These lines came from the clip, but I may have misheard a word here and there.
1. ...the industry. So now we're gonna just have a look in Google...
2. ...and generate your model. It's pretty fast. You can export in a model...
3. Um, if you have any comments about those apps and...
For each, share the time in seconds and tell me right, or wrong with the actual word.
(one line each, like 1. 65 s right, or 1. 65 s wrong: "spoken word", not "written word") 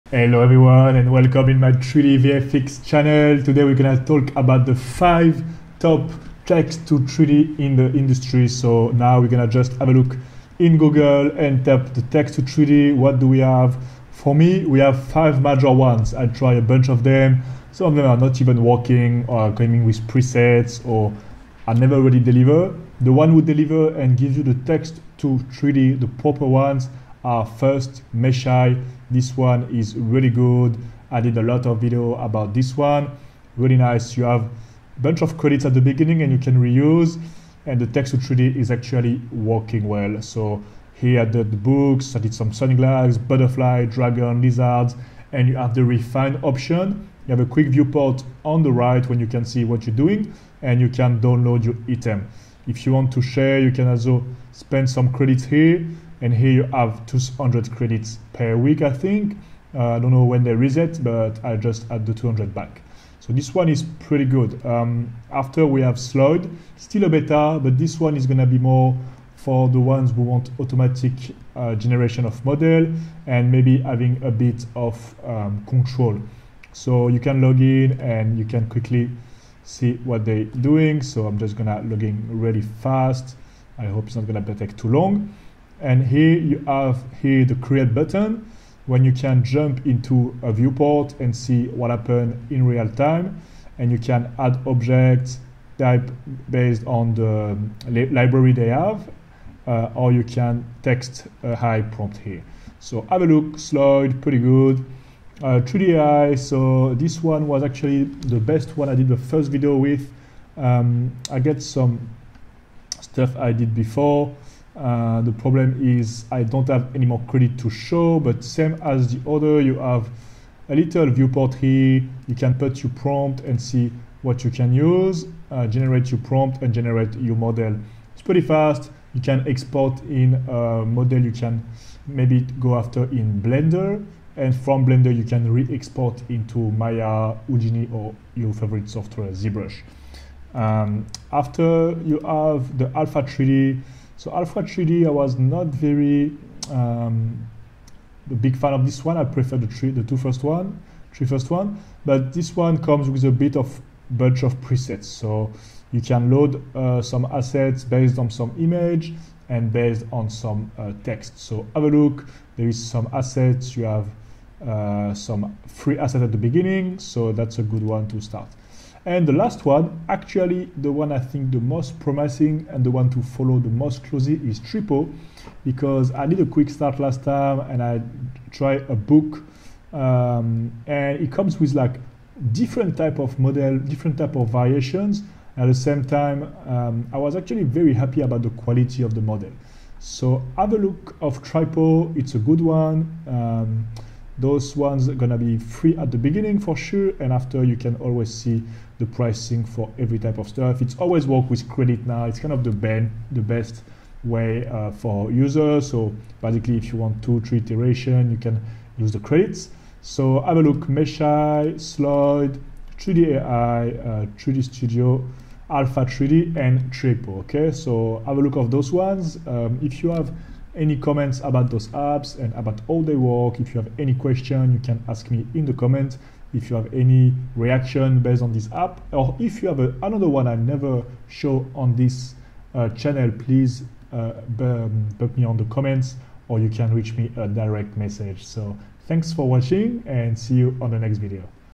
1. 7 s right
2. 126 s right
3. 219 s right.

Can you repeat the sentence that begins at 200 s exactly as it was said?
It's always work with credit now.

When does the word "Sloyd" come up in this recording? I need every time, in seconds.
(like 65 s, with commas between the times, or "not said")
65 s, 103 s, 211 s.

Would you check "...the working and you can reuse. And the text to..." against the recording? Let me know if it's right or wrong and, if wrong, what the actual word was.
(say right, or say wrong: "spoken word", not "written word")
wrong: "beginning", not "working".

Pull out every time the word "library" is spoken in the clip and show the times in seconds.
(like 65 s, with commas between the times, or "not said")
98 s.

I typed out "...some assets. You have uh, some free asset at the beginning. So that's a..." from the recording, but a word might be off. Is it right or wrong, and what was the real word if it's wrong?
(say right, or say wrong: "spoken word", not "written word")
right.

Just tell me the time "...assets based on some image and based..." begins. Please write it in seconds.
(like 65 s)
157 s.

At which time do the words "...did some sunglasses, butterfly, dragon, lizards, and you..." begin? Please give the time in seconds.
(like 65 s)
42 s.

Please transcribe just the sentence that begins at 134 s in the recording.
And from Blender, you can re-export into Maya, Houdini, or your favorite software, ZBrush.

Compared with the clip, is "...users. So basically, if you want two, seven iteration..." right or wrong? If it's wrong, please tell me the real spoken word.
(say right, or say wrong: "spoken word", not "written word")
wrong: "three", not "seven".